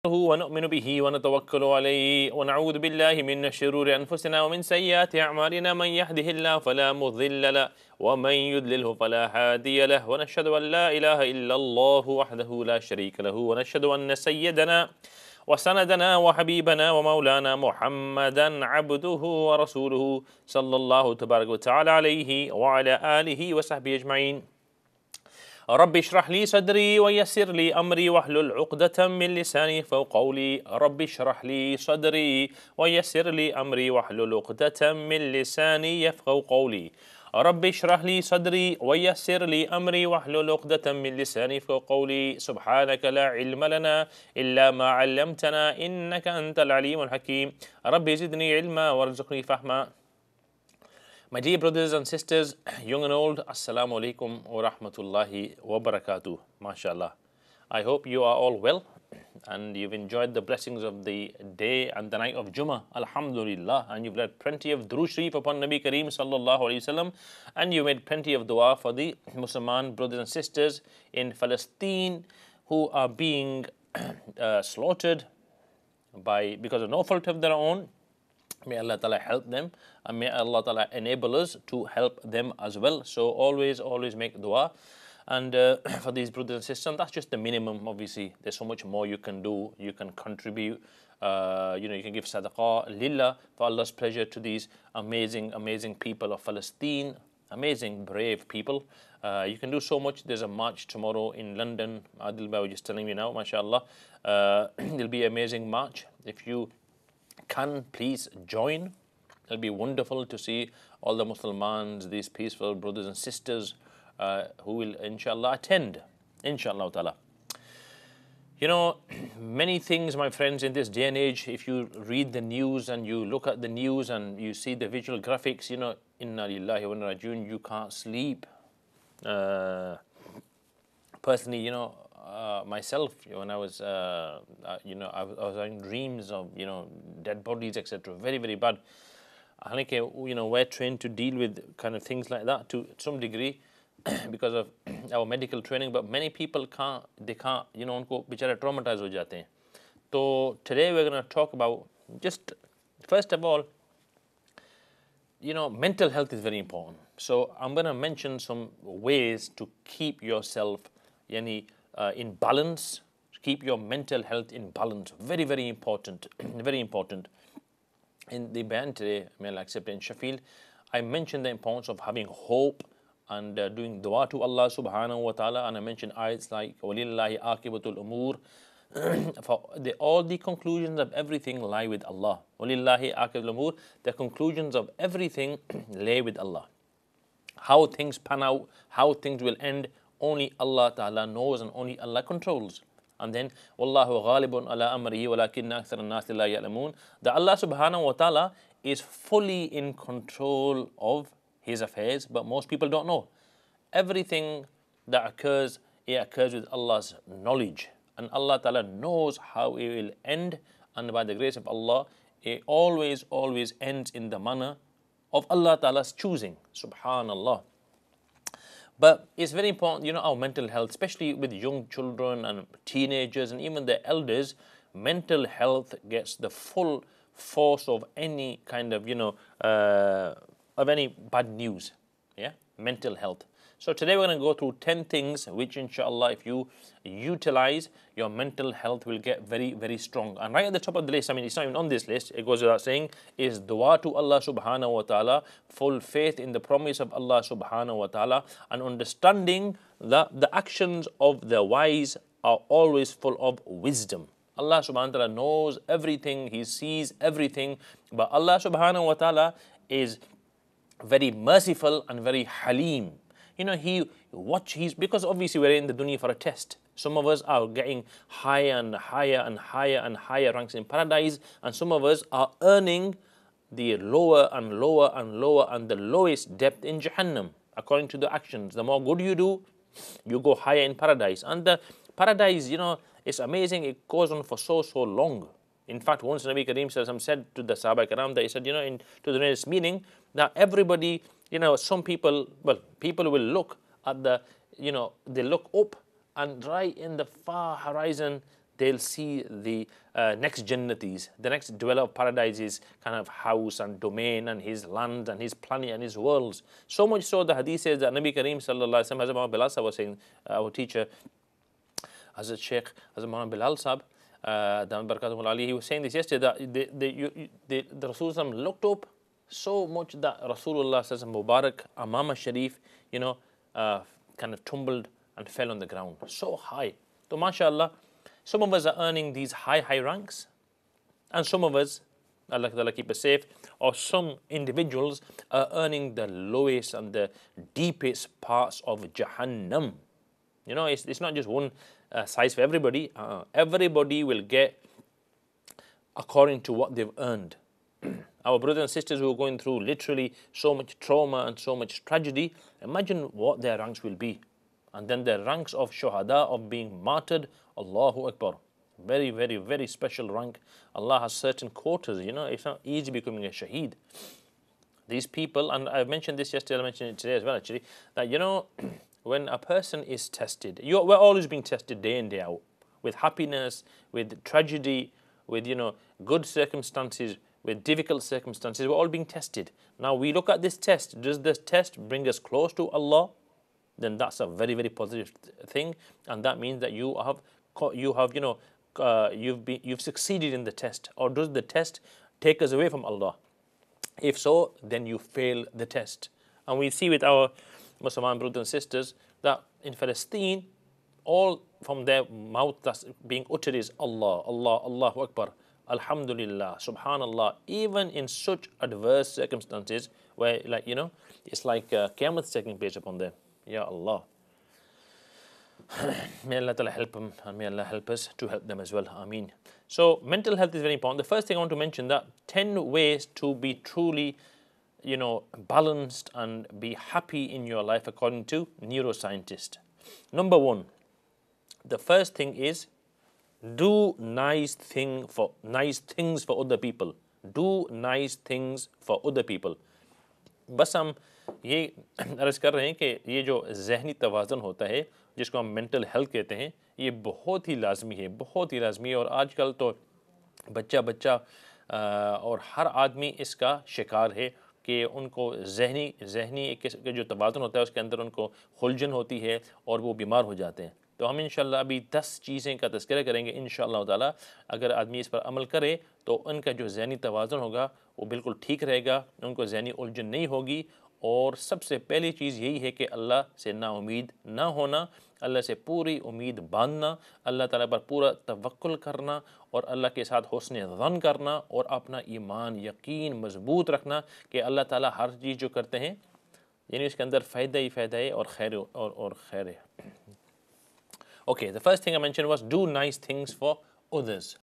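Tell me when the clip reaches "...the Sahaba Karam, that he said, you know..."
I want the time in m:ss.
4:47.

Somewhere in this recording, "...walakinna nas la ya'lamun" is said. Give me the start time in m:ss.
3:15.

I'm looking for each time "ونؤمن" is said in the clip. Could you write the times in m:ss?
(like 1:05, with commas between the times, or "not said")
0:00.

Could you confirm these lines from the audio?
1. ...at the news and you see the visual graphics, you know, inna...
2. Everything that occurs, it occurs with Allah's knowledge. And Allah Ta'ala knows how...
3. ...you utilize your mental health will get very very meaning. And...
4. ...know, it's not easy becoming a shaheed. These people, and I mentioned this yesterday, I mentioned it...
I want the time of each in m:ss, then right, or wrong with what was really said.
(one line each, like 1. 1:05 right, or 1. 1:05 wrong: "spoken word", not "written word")
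1. 2:03 right
2. 3:23 right
3. 3:56 wrong: "strong", not "meaning"
4. 6:02 right.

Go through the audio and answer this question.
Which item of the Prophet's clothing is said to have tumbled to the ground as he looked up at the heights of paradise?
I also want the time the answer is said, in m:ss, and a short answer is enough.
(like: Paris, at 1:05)
Amama Sharif, at 5:21.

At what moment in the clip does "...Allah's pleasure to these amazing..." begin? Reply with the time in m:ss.
1:33.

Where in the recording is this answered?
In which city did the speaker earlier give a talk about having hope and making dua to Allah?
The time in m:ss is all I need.
2:49.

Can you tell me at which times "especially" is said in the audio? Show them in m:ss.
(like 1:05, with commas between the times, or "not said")
3:40.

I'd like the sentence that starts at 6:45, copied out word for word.
Alhamdulillah, subhanallah, even in such adverse circumstances where, like, you know, it's like uh, Qiyamah taking place upon them.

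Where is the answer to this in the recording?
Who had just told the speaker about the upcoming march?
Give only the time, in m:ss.
1:42.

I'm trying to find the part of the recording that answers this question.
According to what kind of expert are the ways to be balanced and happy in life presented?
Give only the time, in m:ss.
7:08.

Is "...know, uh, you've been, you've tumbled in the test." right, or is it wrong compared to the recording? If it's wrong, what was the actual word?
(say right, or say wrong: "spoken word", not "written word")
wrong: "succeeded", not "tumbled".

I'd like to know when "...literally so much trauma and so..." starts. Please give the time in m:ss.
5:49.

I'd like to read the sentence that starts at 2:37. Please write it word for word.
So I'm going to mention some ways to keep yourself, yani, uh, in balance.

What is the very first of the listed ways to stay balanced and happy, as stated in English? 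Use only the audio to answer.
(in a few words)
do nice things for others.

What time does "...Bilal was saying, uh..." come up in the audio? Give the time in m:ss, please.
5:09.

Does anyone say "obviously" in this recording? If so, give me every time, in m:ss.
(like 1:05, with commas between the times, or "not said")
1:27, 4:25.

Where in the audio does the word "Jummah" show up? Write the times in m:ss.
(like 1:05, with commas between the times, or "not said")
1:02.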